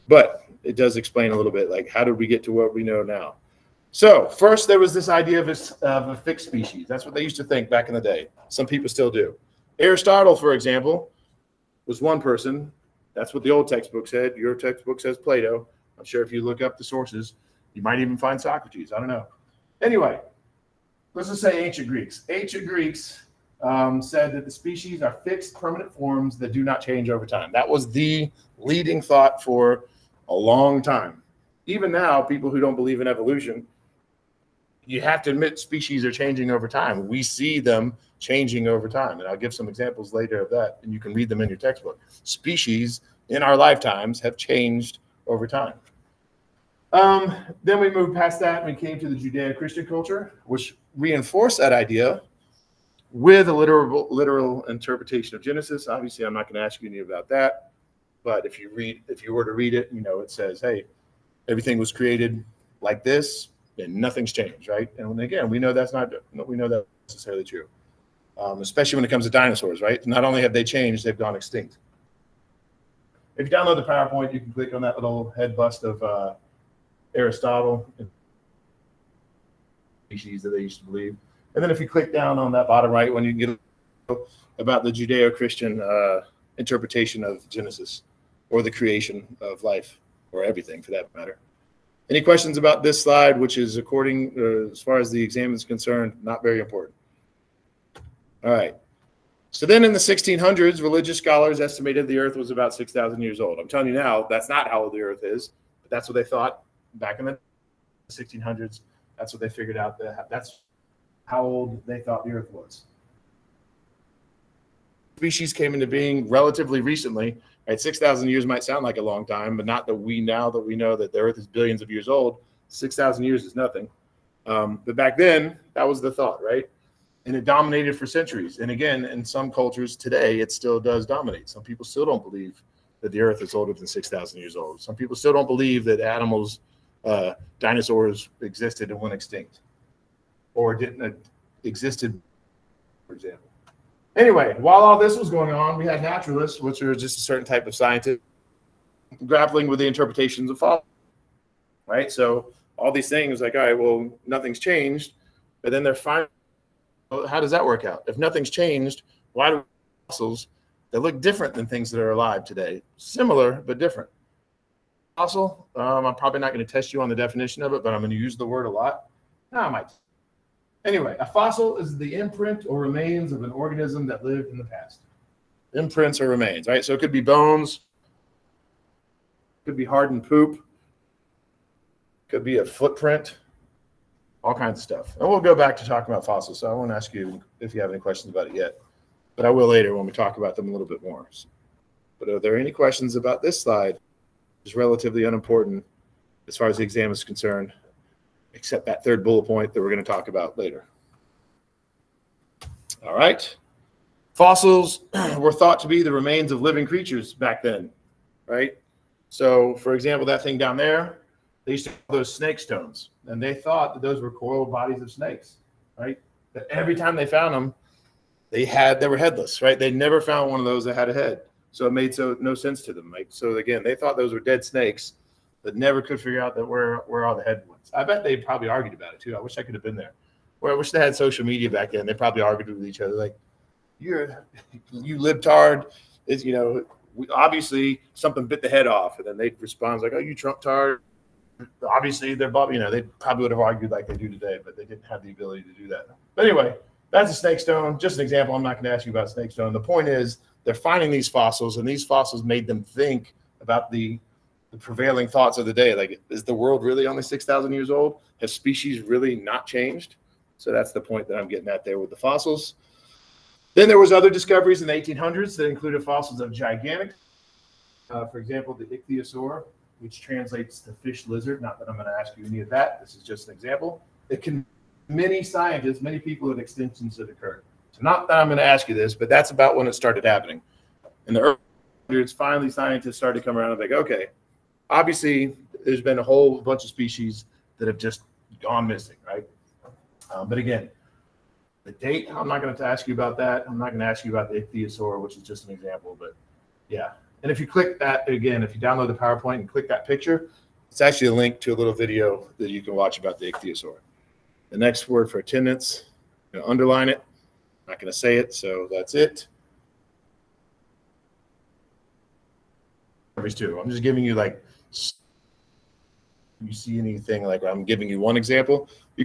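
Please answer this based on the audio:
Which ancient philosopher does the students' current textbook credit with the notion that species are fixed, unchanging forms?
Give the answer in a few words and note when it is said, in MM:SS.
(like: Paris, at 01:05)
Plato, at 00:15.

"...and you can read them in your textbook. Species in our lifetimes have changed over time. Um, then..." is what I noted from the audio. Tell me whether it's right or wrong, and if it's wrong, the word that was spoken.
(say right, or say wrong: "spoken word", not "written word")
right.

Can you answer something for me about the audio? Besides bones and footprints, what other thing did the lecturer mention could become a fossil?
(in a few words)
poop.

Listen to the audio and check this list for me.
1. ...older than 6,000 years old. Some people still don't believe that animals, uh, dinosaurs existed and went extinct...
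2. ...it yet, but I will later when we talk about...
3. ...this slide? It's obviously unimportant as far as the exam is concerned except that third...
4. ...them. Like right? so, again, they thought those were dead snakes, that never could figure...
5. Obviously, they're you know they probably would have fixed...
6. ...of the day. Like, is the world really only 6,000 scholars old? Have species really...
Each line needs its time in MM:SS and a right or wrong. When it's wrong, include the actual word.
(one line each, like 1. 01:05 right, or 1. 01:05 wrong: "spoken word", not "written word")
1. 02:13 right
2. 03:08 right
3. 03:13 wrong: "relatively", not "obviously"
4. 03:42 right
5. 04:01 wrong: "argued", not "fixed"
6. 04:15 wrong: "years", not "scholars".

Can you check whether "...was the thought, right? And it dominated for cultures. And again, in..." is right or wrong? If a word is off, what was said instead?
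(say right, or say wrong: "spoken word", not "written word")
wrong: "centuries", not "cultures".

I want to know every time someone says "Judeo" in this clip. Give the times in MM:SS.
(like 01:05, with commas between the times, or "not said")
00:49, 01:24.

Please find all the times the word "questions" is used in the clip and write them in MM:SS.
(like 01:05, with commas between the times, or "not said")
01:32, 03:08, 03:12.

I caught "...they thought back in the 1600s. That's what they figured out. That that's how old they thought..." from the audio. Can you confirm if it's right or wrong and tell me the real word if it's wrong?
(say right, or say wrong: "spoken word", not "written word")
right.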